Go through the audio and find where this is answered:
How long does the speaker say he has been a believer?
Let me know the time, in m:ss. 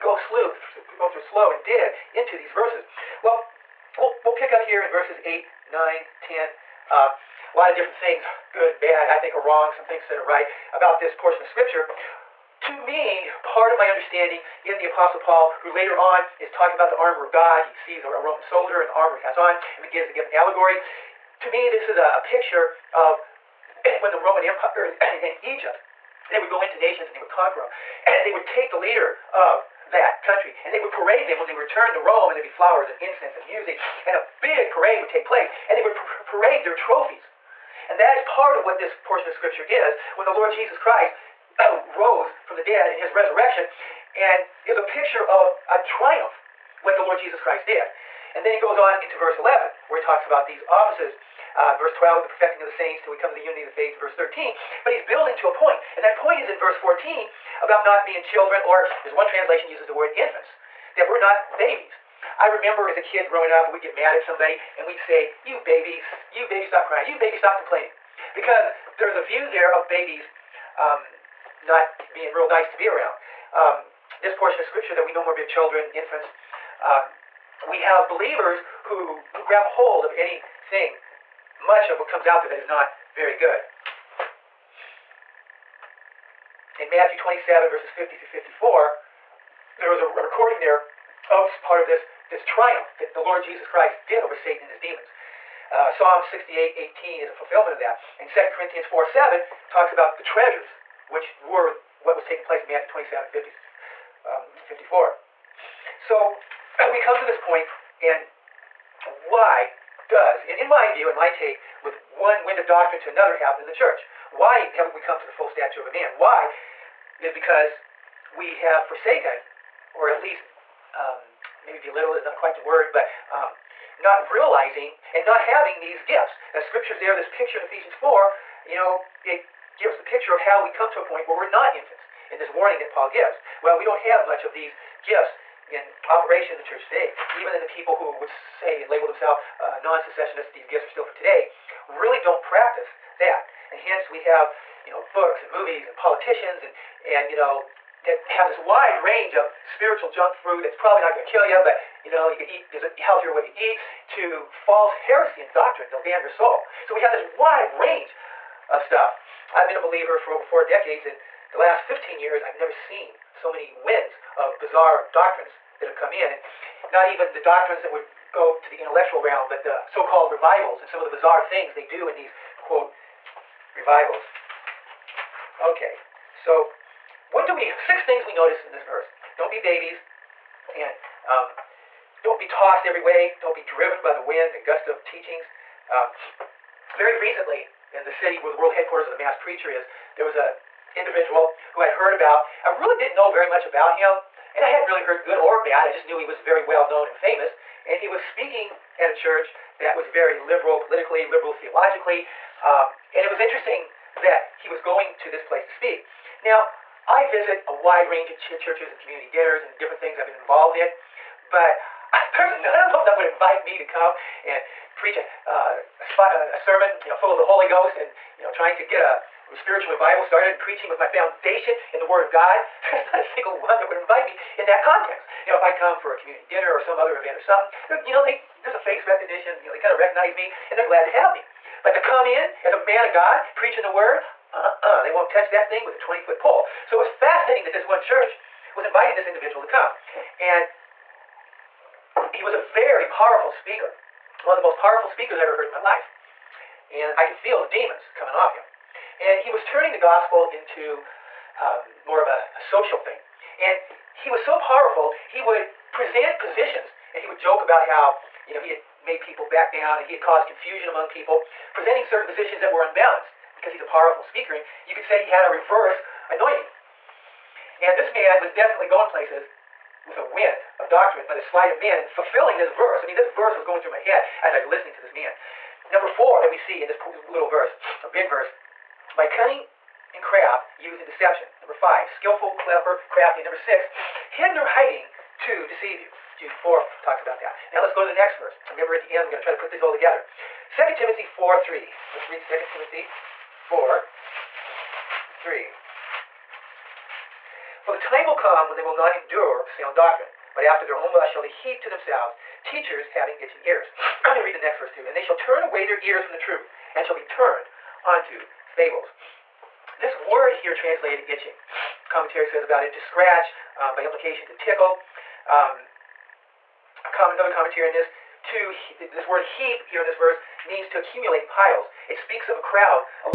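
2:40.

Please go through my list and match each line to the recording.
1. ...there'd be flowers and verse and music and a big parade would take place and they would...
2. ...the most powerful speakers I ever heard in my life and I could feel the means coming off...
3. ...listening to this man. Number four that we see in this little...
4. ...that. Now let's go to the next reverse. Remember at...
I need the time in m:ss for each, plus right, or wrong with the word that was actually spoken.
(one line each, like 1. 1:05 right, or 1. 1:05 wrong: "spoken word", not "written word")
1. 0:32 wrong: "incense", not "verse"
2. 4:04 wrong: "demons", not "means"
3. 4:34 right
4. 4:47 wrong: "verse", not "reverse".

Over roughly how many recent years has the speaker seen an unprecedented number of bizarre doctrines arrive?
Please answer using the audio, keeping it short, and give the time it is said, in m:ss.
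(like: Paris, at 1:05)
15 years, at 2:41.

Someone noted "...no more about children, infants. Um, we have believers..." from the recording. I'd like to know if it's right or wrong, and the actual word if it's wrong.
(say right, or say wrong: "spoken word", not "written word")
right.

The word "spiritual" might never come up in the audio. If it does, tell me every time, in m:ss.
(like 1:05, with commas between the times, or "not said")
2:29, 3:39.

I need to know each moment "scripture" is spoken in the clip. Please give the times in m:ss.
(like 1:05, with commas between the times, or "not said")
0:11, 0:39, 1:14, 2:06.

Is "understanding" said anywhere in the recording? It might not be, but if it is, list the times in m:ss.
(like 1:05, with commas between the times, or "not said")
0:13.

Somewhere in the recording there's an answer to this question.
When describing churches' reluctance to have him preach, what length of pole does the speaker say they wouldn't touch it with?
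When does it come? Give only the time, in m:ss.
3:55.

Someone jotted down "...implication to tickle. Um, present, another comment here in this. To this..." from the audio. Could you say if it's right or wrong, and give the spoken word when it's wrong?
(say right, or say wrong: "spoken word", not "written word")
wrong: "comment", not "present".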